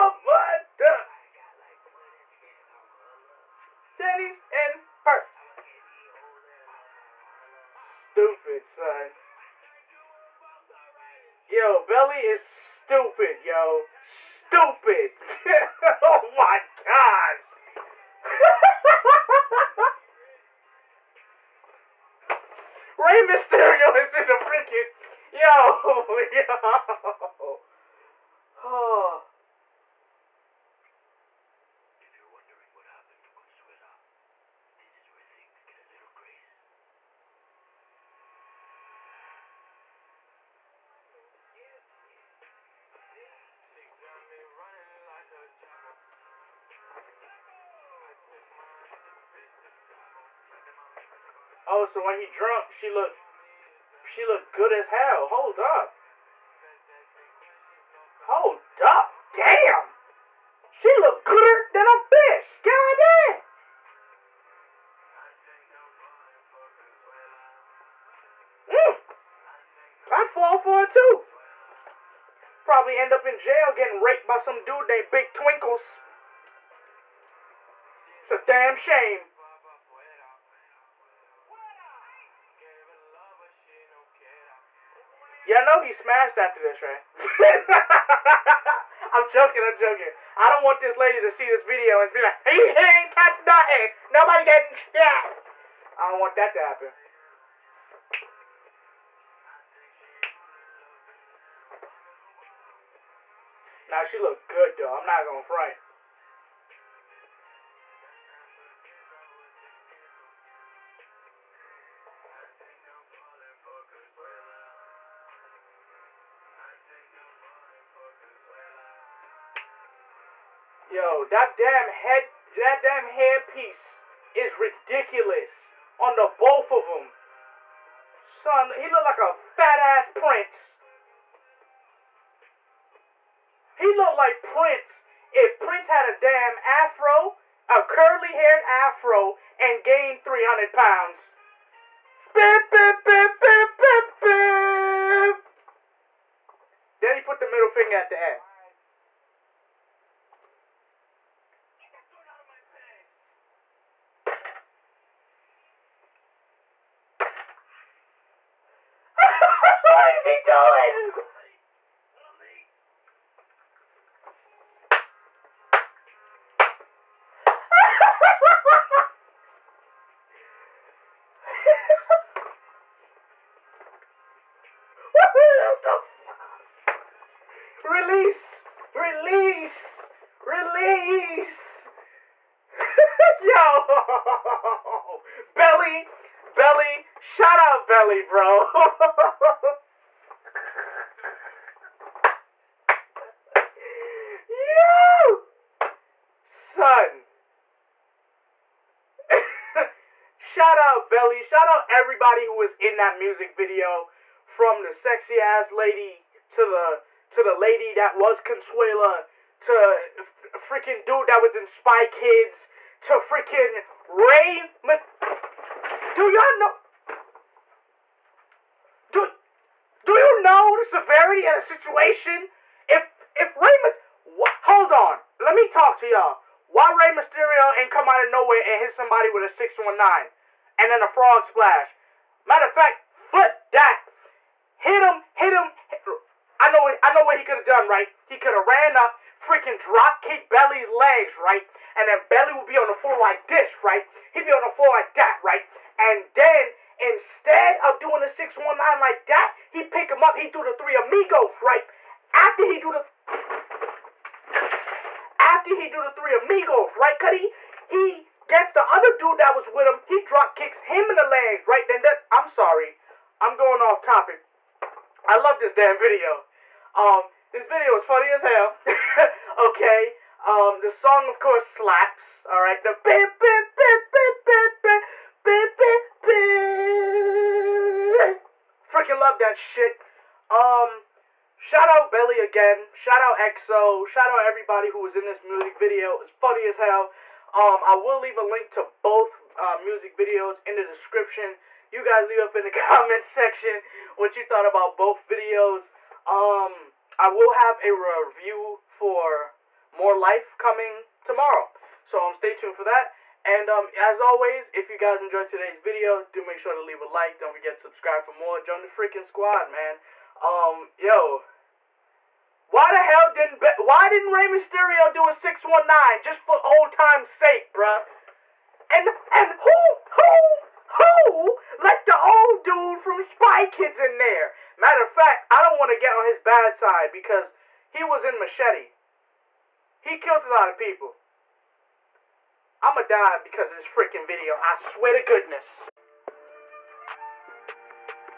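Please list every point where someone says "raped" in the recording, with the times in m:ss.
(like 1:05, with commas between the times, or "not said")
1:14.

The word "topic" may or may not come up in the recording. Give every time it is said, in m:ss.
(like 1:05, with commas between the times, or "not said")
4:24.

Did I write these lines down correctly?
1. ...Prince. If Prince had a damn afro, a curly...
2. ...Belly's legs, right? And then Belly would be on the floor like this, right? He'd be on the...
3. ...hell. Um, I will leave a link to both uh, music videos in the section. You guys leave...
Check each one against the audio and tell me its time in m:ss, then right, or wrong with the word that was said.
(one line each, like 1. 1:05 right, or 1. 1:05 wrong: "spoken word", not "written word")
1. 2:14 right
2. 4:00 right
3. 4:46 wrong: "description", not "section".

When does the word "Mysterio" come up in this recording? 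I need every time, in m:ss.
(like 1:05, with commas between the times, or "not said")
0:23, 3:47, 5:14.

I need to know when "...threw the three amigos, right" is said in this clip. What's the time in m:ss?
4:10.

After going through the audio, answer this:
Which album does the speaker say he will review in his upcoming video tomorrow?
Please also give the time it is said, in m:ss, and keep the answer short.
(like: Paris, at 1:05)
More Life, at 4:59.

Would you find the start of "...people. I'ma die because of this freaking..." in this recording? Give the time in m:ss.
5:30.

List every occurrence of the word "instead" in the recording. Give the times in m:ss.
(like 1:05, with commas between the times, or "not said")
4:06.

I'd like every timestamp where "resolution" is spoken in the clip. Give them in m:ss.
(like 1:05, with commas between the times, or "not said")
not said.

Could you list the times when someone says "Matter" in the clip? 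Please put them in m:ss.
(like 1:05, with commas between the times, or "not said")
3:52, 5:24.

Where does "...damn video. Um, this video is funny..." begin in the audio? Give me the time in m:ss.
4:25.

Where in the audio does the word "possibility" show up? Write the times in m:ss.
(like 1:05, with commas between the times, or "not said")
not said.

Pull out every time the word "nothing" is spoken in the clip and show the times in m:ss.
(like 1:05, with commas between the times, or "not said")
1:33.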